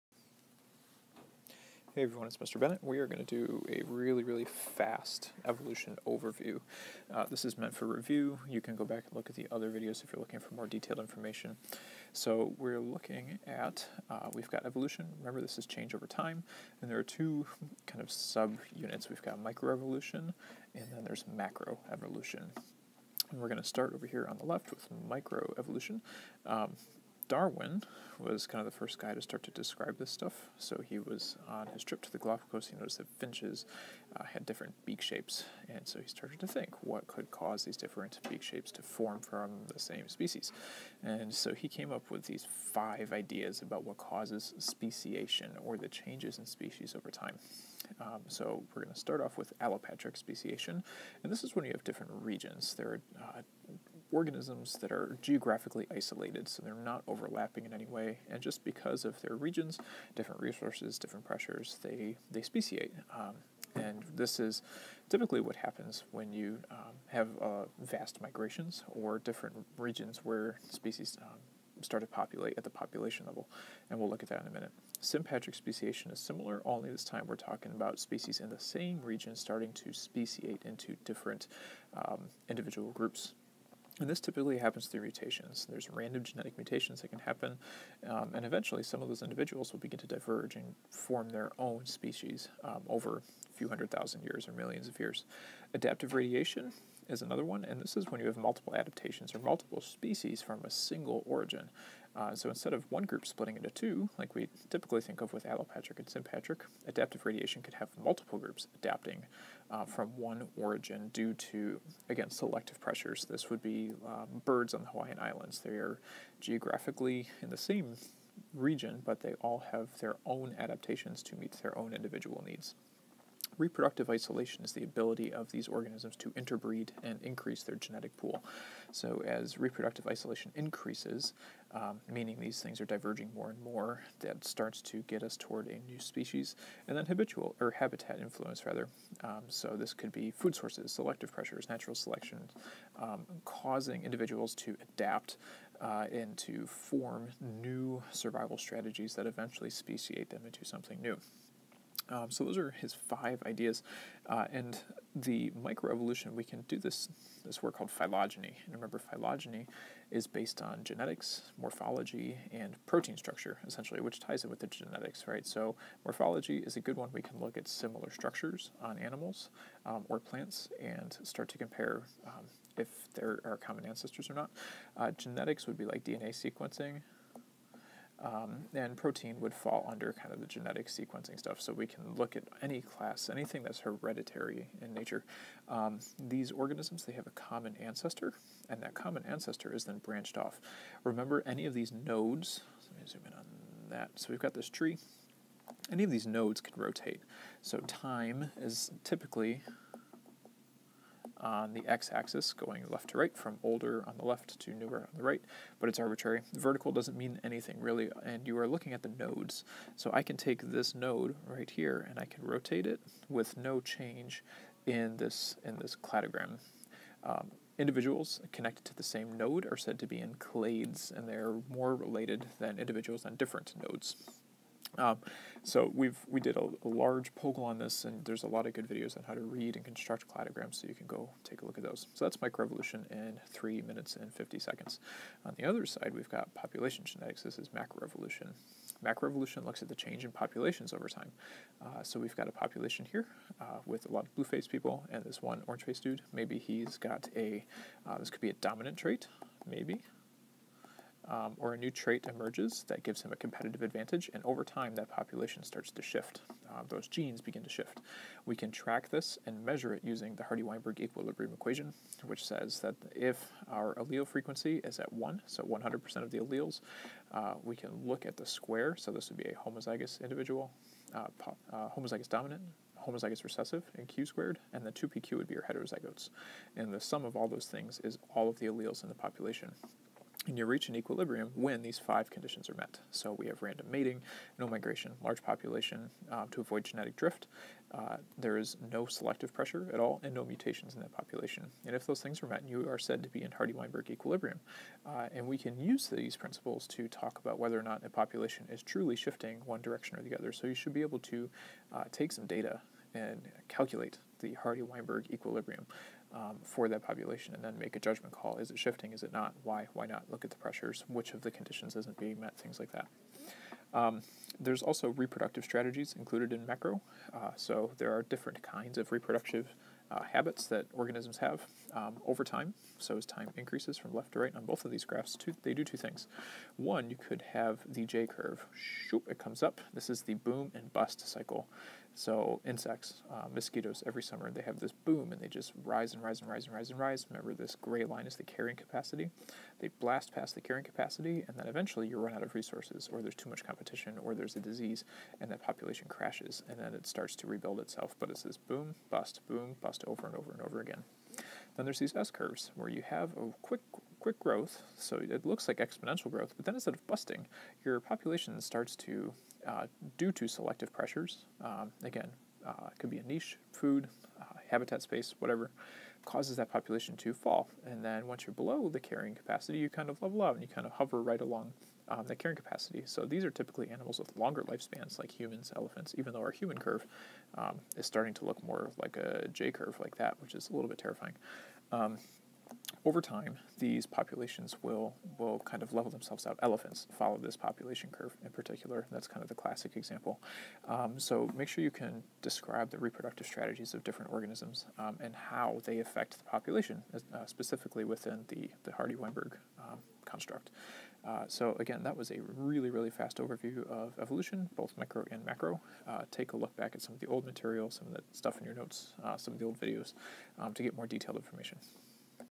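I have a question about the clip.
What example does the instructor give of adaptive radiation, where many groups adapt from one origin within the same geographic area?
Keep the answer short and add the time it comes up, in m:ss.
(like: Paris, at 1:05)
Birds on the Hawaiian Islands, at 1:54.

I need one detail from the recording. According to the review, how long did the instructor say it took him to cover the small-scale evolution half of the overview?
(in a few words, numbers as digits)
3 minutes and 50 seconds.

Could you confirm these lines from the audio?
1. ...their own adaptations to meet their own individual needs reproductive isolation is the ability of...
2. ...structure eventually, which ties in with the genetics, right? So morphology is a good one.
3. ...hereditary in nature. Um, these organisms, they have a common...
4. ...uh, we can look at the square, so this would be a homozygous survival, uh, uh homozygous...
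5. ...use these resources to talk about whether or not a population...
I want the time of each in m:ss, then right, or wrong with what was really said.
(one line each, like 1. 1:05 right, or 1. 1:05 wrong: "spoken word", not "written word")
1. 1:59 right
2. 2:43 wrong: "essentially", not "eventually"
3. 3:03 right
4. 4:27 wrong: "individual", not "survival"
5. 4:55 wrong: "principles", not "resources".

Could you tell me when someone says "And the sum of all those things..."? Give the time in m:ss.
4:36.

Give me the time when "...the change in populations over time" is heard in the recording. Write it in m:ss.
3:59.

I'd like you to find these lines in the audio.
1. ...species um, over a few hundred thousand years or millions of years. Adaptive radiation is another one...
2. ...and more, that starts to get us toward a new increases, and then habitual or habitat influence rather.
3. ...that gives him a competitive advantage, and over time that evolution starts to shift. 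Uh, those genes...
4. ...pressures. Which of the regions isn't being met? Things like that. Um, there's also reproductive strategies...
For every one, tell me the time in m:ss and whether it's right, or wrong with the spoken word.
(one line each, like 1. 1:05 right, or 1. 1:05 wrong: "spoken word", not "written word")
1. 1:31 right
2. 2:13 wrong: "species", not "increases"
3. 4:12 wrong: "population", not "evolution"
4. 5:10 wrong: "conditions", not "regions".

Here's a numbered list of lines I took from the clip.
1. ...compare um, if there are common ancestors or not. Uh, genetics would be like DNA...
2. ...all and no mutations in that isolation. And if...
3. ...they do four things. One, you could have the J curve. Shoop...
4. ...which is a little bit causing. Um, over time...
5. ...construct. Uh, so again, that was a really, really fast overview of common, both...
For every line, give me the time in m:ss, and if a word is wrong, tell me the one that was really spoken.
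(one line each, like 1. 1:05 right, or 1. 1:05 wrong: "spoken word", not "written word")
1. 2:51 right
2. 4:49 wrong: "population", not "isolation"
3. 5:25 wrong: "two", not "four"
4. 6:20 wrong: "terrifying", not "causing"
5. 6:40 wrong: "evolution", not "common".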